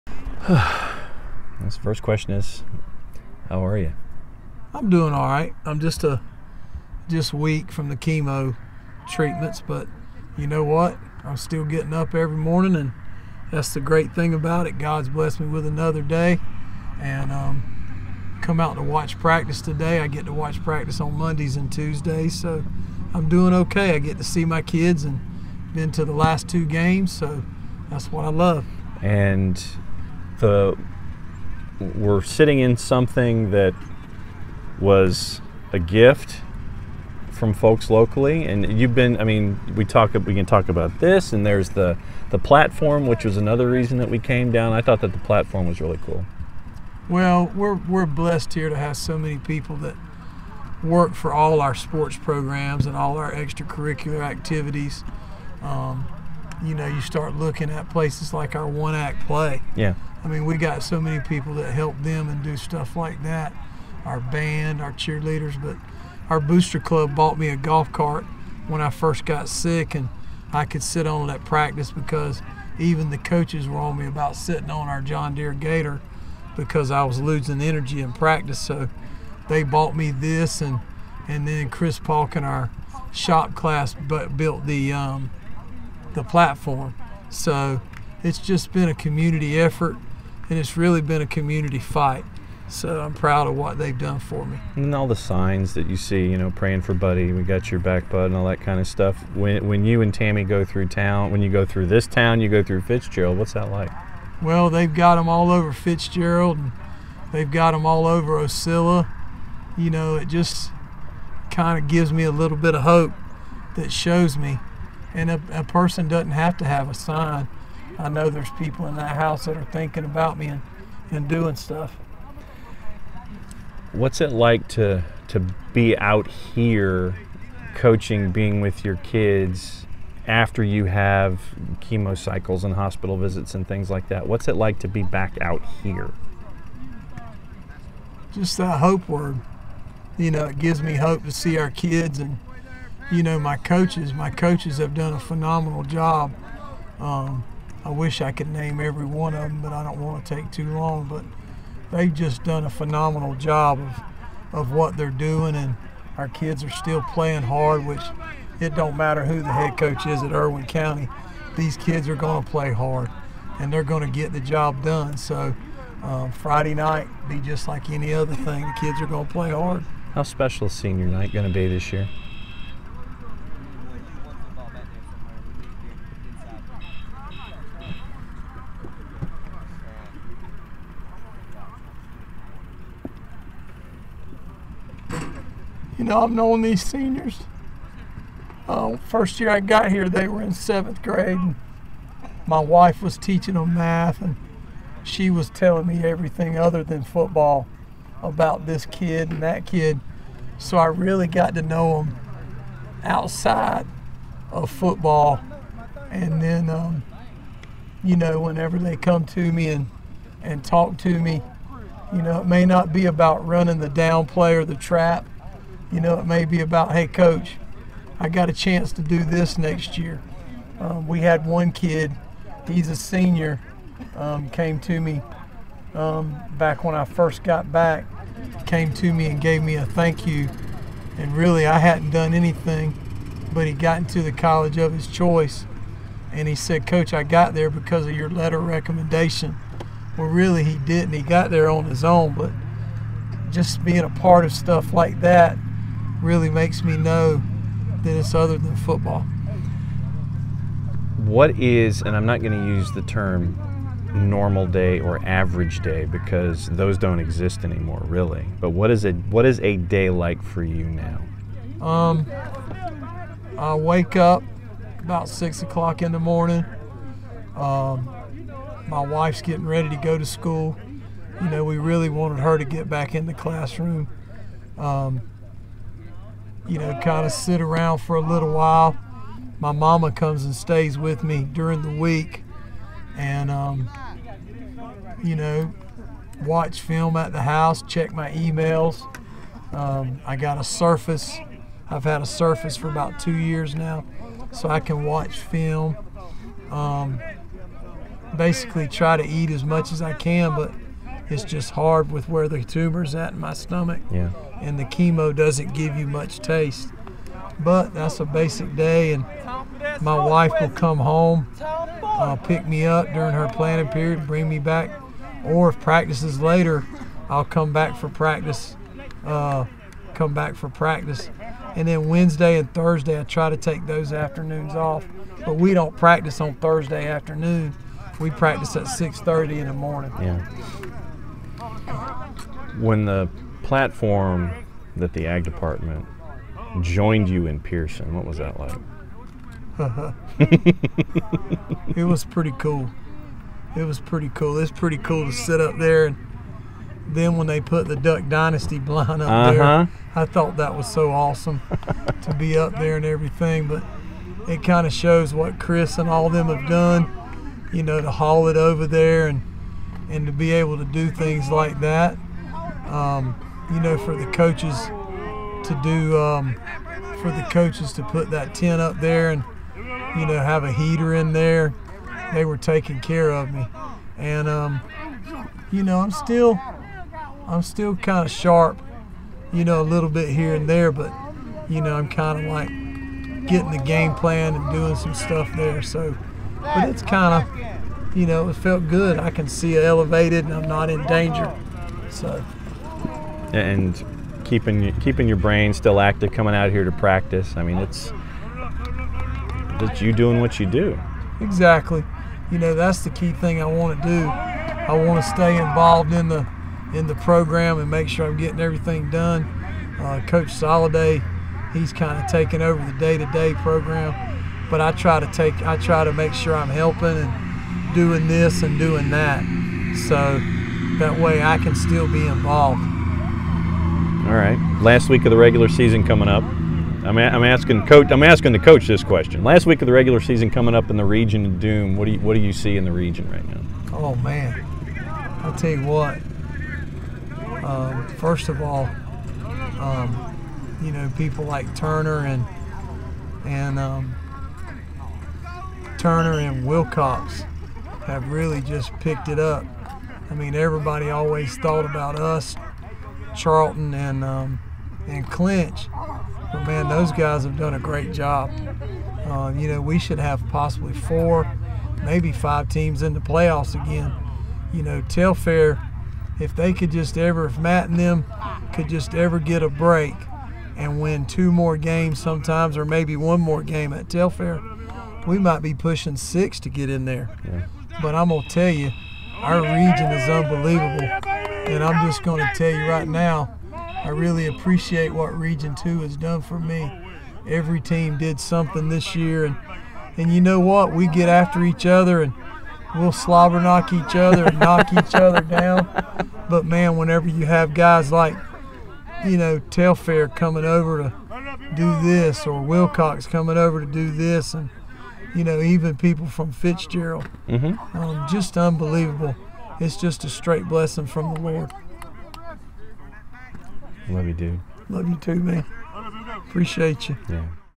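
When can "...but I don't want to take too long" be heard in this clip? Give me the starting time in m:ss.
2:29.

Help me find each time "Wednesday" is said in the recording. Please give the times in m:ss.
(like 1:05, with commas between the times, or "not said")
5:22.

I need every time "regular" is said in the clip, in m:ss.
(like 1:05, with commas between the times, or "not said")
7:05, 7:09.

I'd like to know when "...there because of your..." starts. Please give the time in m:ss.
3:57.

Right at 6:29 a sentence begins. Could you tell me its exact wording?
I can see elevated and I'm not in danger.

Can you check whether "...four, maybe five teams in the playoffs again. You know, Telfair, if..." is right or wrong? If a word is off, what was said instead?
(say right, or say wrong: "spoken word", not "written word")
right.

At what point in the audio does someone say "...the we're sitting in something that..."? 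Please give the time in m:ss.
0:30.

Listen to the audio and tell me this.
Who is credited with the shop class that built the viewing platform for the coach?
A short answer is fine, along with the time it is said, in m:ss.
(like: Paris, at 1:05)
Chris Palkin, at 1:21.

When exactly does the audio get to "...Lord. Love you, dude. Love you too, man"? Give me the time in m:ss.
8:31.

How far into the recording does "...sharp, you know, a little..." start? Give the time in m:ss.
6:18.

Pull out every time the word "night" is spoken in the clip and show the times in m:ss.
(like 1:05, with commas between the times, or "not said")
2:46, 2:51.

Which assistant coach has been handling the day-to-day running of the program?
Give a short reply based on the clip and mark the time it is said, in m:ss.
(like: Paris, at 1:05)
Coach Soliday, at 6:50.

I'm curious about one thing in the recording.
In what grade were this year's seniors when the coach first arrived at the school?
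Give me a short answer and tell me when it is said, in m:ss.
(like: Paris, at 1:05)
seventh grade, at 3:10.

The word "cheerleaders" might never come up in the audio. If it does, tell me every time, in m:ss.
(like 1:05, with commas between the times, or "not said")
1:04.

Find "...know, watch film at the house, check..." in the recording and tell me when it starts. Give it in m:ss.
4:45.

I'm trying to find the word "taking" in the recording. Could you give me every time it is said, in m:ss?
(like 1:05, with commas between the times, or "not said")
6:12, 6:52.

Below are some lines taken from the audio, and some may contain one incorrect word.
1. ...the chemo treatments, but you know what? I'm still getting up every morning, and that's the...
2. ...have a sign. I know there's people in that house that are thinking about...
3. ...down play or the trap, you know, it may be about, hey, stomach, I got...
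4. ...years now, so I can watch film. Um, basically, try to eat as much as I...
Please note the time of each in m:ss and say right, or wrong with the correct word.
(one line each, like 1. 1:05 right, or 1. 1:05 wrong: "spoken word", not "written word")
1. 0:07 right
2. 1:56 right
3. 3:33 wrong: "coach", not "stomach"
4. 4:53 right.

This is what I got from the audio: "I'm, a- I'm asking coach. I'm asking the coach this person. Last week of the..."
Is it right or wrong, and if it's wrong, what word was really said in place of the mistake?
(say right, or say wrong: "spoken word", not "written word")
wrong: "question", not "person".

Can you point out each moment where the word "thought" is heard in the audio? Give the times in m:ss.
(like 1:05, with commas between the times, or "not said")
0:44, 5:50, 7:31.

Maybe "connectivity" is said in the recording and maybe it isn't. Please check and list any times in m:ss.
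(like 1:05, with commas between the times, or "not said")
not said.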